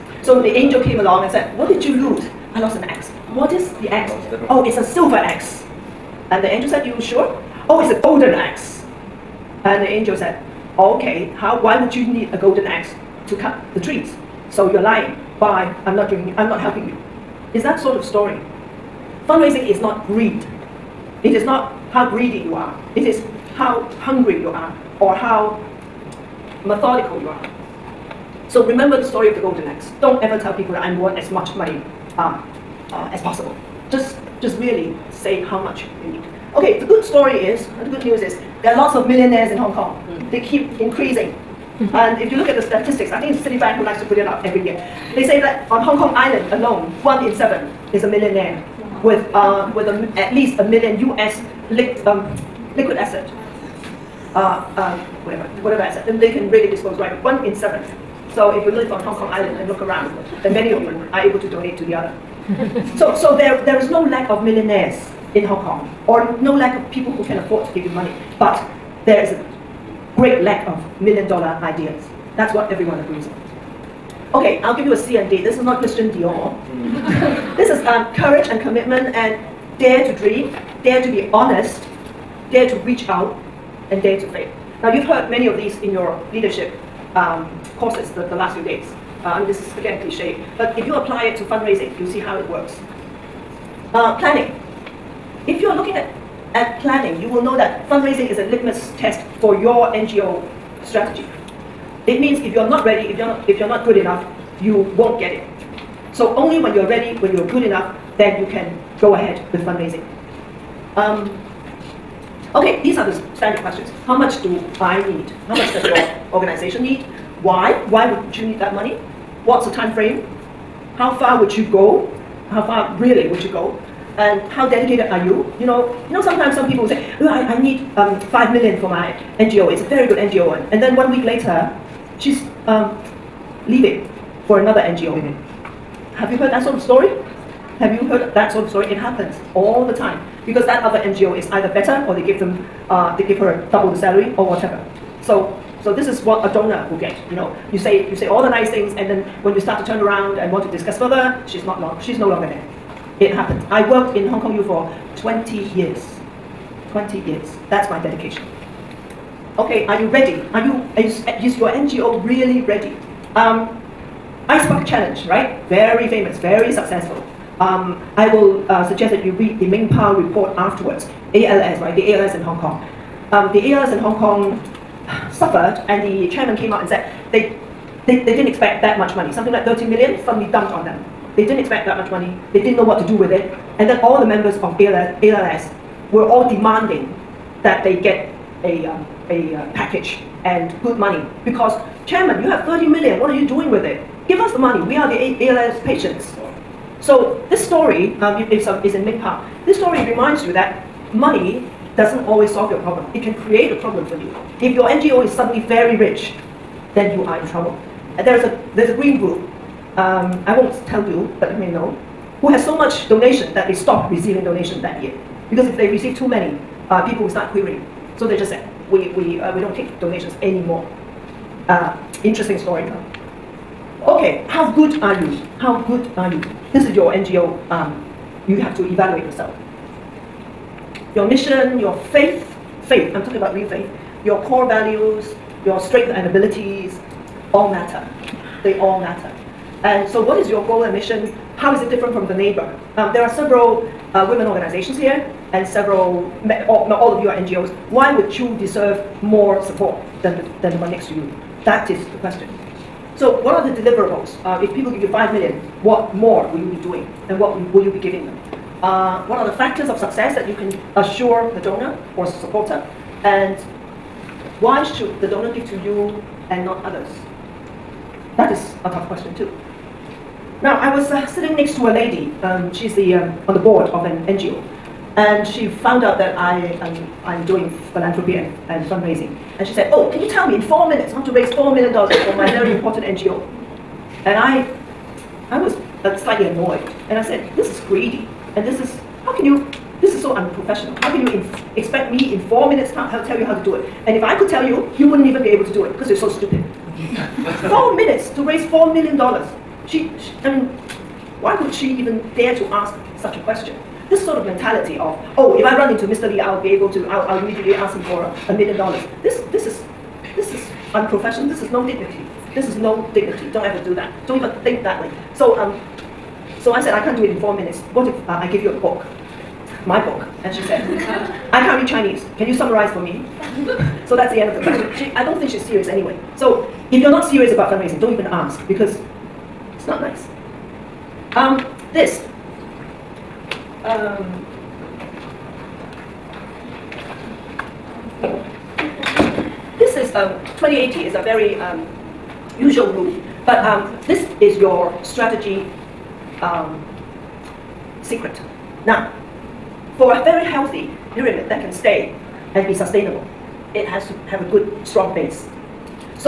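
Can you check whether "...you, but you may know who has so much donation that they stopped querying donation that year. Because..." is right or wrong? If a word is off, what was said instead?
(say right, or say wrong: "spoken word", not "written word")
wrong: "receiving", not "querying".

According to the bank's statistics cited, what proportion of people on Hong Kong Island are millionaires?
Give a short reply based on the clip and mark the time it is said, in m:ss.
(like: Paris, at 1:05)
1 in 7, at 0:47.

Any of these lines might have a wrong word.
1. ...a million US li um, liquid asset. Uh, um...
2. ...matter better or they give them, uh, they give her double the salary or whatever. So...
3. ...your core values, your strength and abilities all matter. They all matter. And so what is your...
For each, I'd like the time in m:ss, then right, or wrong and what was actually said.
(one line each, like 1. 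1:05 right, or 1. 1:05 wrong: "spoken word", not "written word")
1. 0:50 right
2. 2:21 wrong: "either", not "matter"
3. 3:54 right.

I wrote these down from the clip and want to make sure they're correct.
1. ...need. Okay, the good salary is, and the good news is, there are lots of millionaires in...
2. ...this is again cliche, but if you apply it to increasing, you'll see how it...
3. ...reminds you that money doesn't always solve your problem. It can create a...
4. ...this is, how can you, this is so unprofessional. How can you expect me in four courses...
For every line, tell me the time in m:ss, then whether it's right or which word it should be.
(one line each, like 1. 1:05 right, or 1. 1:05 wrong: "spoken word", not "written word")
1. 0:36 wrong: "story", not "salary"
2. 1:29 wrong: "fundraising", not "increasing"
3. 3:20 right
4. 4:48 wrong: "minutes", not "courses".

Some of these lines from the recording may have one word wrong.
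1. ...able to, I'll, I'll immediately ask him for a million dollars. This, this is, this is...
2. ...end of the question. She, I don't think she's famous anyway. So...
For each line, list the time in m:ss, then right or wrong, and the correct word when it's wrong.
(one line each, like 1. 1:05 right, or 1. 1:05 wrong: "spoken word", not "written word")
1. 5:06 right
2. 5:24 wrong: "serious", not "famous".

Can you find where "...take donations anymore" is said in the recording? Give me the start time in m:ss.
3:39.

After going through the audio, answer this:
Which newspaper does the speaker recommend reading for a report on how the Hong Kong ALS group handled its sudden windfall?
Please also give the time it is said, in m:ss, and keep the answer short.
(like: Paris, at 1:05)
Ming Pao, at 2:49.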